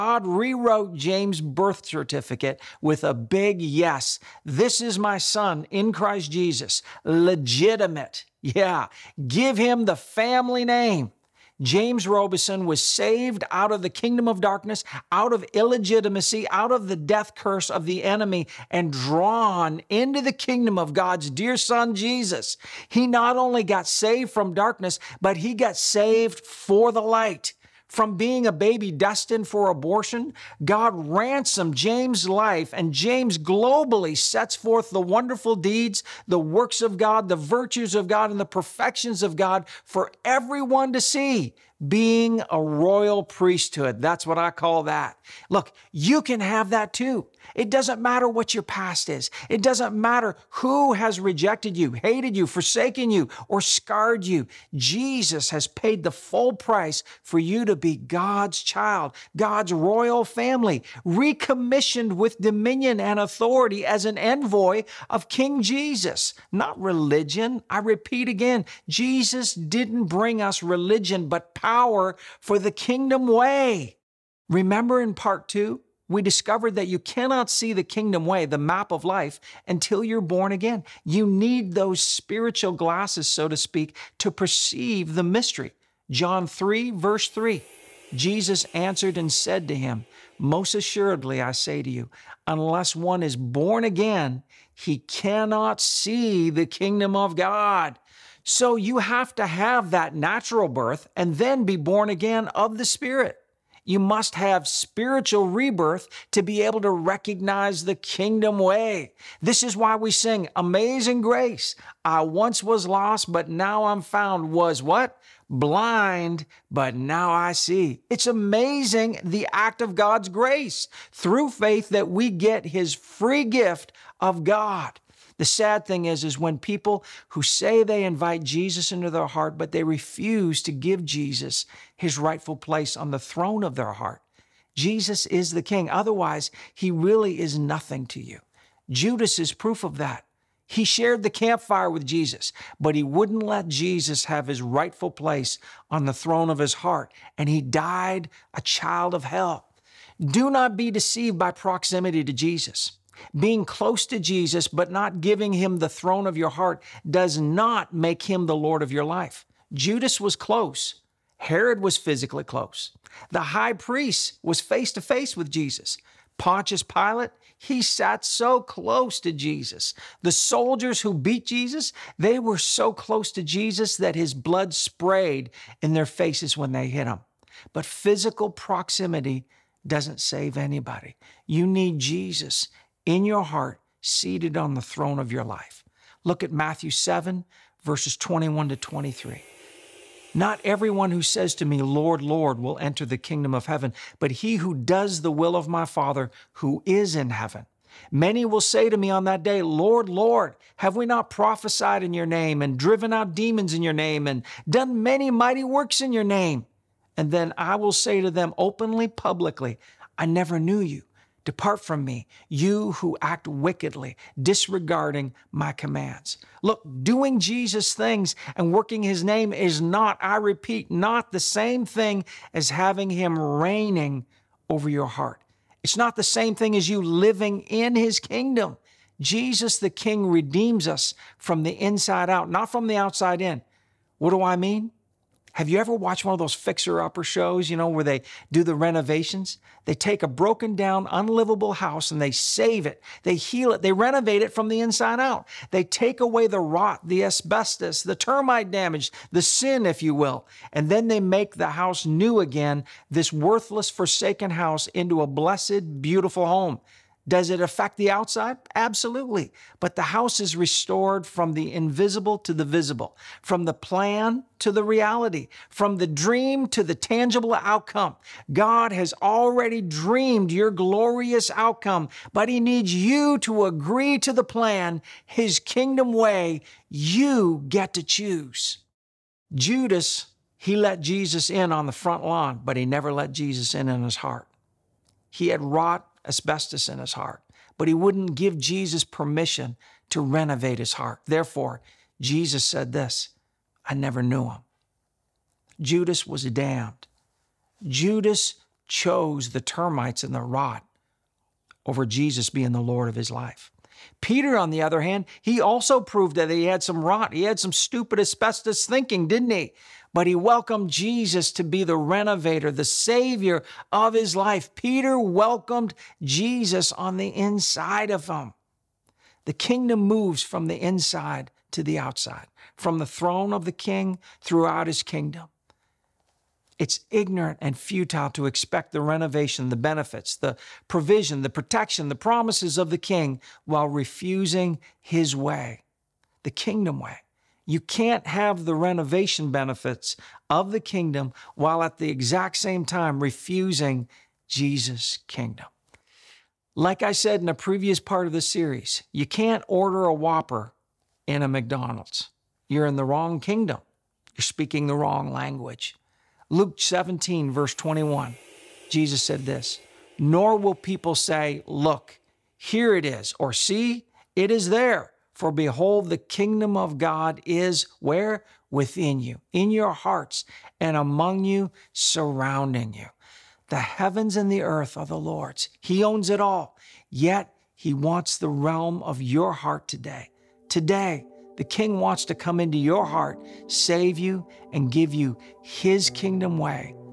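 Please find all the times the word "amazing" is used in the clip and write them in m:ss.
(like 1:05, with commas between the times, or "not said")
1:50, 1:58.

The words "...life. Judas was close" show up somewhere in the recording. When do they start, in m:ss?
2:39.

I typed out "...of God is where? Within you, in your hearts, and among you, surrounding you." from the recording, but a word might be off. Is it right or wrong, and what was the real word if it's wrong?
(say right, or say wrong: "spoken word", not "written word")
right.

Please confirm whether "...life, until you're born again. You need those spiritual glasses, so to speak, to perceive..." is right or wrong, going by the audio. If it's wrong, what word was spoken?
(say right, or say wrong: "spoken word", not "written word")
right.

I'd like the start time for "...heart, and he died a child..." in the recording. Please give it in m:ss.
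2:26.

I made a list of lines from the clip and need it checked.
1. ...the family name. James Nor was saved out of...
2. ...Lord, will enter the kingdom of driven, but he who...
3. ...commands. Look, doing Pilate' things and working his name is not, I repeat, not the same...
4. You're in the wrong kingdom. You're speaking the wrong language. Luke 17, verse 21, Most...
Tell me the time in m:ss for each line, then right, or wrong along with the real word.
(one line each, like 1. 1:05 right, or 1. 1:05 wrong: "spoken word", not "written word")
1. 0:09 wrong: "Robison", not "Nor"
2. 3:12 wrong: "heaven", not "driven"
3. 3:35 wrong: "Jesus", not "Pilate"
4. 5:52 wrong: "Jesus", not "Most".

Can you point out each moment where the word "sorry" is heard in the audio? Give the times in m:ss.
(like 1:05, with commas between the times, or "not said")
not said.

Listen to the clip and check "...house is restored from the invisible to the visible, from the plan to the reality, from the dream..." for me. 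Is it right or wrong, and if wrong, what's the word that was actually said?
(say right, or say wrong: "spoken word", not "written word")
right.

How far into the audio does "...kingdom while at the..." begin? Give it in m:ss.
5:40.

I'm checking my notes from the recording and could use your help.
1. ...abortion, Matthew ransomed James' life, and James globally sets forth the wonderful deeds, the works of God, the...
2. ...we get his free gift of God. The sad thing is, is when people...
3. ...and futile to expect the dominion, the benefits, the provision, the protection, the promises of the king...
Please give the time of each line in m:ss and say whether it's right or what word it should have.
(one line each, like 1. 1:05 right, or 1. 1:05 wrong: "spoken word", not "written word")
1. 0:29 wrong: "God", not "Matthew"
2. 2:02 right
3. 5:27 wrong: "renovation", not "dominion".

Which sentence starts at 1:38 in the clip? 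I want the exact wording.
So you have to have that natural birth and then be born again of the Spirit.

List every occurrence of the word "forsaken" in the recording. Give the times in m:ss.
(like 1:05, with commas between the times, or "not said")
0:52, 4:13.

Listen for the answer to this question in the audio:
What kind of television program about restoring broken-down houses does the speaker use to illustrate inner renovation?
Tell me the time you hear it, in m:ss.
3:56.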